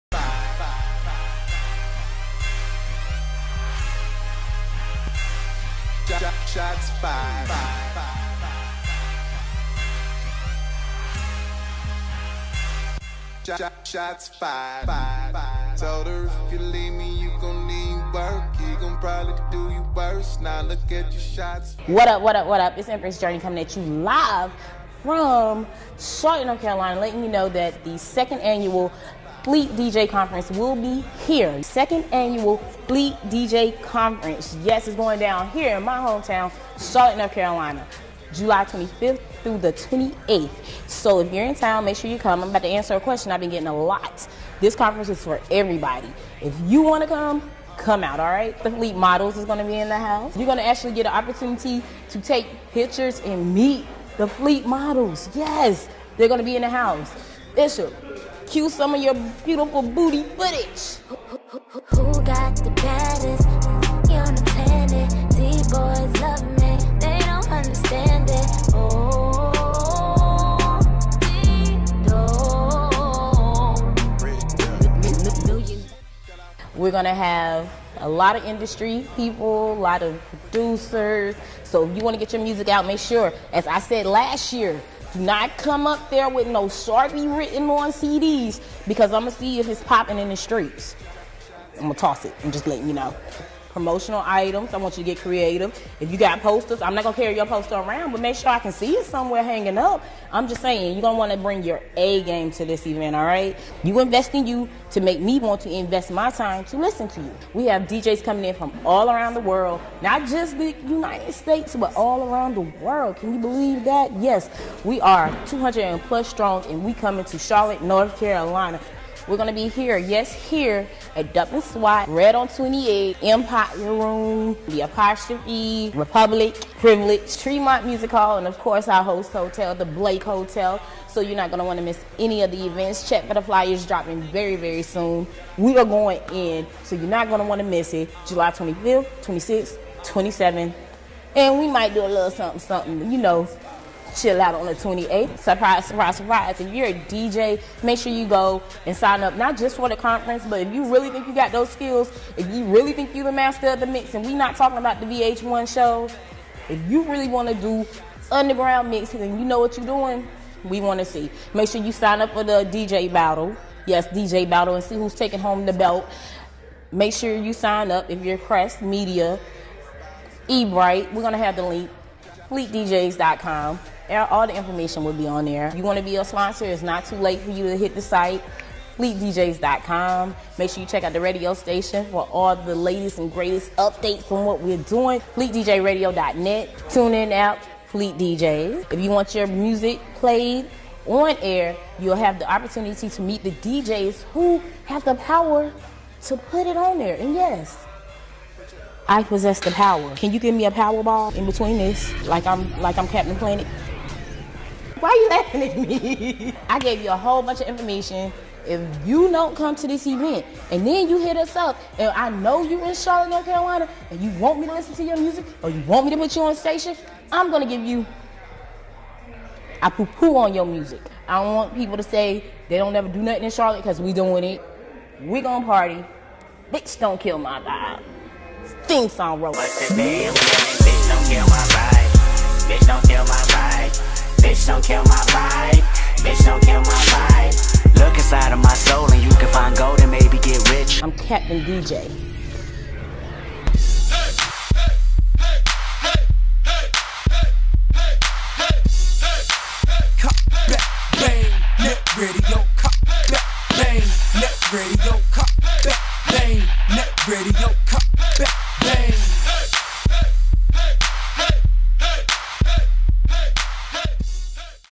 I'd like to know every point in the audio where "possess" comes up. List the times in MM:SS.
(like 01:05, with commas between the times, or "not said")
03:19.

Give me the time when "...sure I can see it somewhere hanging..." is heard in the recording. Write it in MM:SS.
01:38.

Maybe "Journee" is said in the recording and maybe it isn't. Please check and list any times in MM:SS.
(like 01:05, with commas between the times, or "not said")
00:23.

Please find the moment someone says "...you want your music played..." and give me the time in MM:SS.
03:08.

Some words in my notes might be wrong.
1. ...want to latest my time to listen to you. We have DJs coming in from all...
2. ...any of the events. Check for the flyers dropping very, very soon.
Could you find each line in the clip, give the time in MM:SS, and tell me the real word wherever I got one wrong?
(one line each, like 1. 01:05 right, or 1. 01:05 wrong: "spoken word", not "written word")
1. 01:45 wrong: "invest", not "latest"
2. 02:12 right.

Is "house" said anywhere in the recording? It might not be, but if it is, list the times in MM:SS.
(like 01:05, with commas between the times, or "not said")
00:49, 00:56.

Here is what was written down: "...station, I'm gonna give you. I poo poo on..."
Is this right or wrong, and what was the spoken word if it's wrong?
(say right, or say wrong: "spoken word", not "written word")
right.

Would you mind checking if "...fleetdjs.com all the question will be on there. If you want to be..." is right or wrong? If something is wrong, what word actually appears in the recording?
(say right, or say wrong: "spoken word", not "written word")
wrong: "information", not "question".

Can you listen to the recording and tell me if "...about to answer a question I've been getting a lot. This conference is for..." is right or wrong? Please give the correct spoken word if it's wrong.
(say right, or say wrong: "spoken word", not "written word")
right.